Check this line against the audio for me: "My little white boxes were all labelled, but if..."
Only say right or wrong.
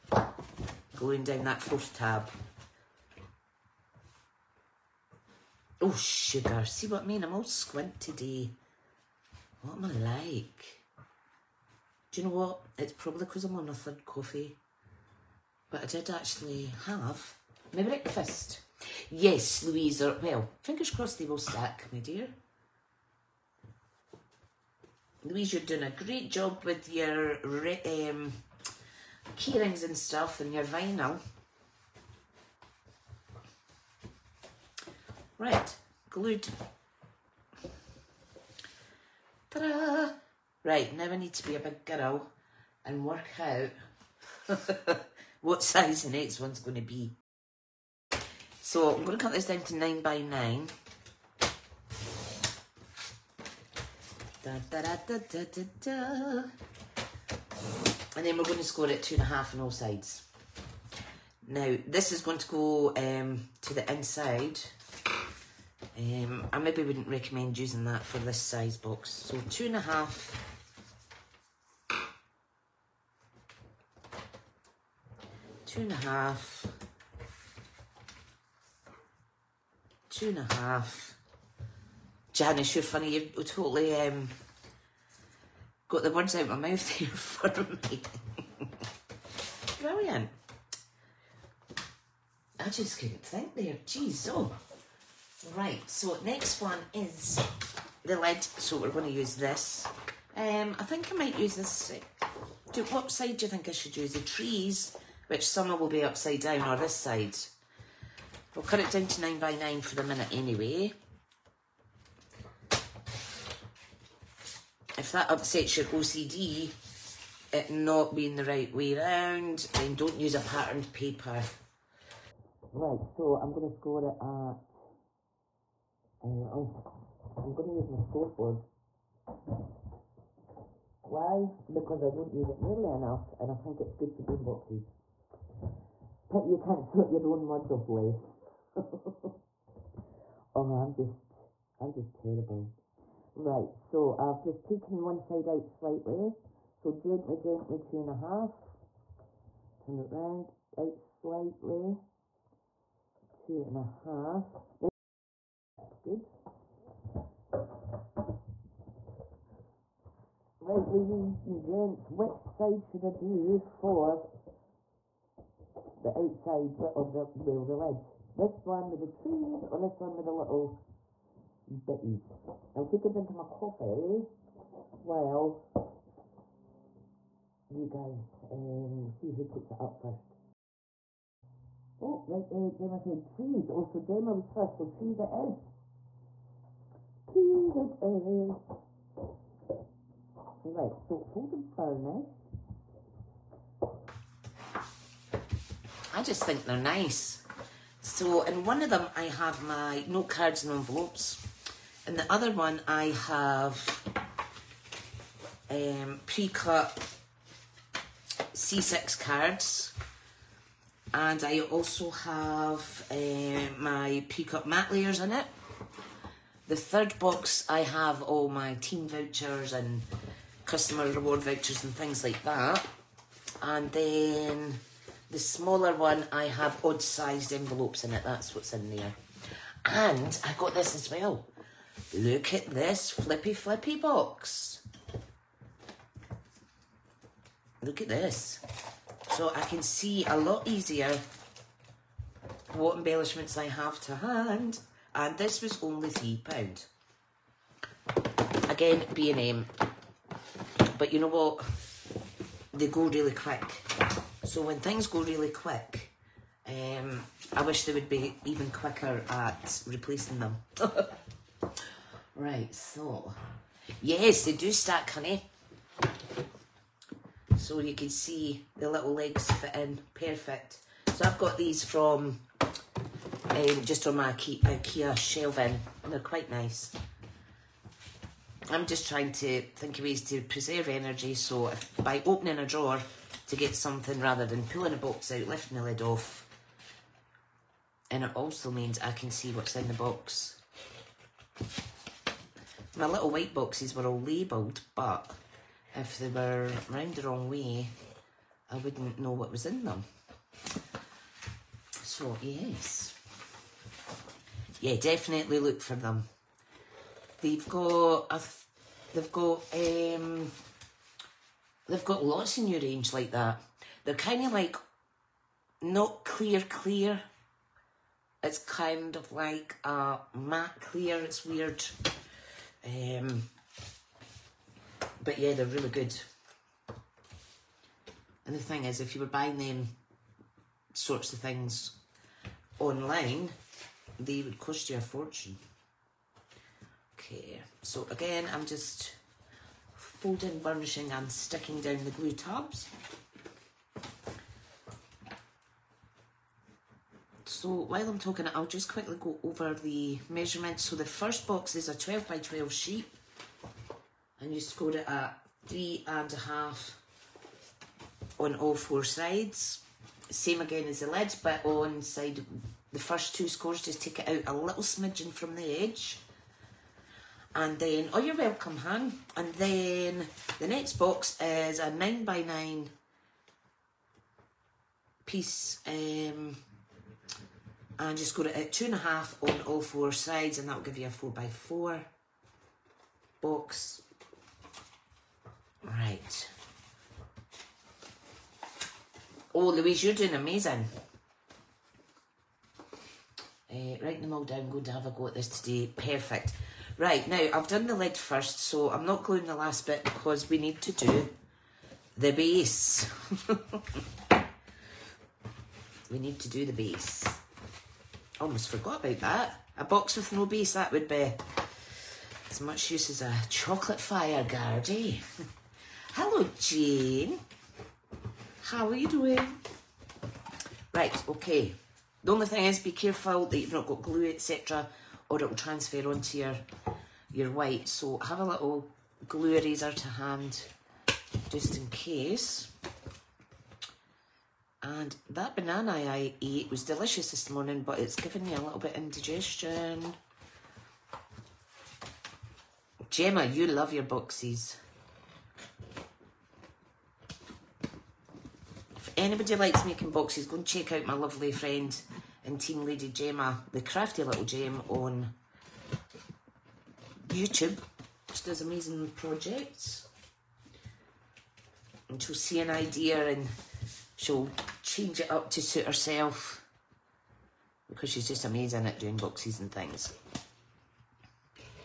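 right.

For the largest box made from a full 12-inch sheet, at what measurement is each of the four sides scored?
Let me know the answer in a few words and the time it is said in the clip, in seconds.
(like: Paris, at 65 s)
3.5, at 355 s.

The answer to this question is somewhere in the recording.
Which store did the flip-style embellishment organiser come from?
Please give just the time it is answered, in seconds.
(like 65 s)
249 s.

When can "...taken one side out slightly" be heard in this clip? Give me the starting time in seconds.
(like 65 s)
144 s.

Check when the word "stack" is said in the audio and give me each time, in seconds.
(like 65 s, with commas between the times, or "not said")
21 s, 264 s.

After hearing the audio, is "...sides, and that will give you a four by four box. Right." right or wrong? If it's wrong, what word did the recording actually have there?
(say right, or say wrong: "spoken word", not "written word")
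right.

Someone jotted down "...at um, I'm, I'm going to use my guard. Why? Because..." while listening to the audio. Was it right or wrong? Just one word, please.
wrong.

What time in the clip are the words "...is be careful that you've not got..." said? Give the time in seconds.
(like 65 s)
422 s.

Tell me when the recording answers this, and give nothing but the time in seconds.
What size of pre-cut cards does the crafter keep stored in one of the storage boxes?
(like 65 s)
208 s.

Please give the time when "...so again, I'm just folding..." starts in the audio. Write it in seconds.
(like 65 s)
337 s.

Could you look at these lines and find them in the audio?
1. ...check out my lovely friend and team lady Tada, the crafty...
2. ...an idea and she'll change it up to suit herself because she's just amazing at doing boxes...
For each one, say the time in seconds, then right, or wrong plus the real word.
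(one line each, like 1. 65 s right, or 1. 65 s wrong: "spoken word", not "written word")
1. 450 s wrong: "Gemma", not "Tada"
2. 462 s right.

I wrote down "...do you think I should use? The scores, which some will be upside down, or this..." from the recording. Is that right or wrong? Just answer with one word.
wrong.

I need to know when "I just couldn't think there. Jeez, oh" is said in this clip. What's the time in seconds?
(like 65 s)
92 s.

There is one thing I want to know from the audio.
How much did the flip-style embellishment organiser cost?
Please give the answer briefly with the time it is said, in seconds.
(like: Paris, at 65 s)
£3, at 246 s.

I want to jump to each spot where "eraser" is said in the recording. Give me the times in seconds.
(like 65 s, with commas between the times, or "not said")
429 s.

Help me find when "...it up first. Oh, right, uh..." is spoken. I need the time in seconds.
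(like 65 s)
179 s.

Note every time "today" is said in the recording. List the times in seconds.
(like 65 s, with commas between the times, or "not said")
7 s, 395 s.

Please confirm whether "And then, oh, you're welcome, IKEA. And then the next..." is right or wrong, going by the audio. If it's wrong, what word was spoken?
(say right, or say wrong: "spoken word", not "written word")
wrong: "Han", not "IKEA".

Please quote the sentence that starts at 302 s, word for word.
So, yes yeah, definitely look for them.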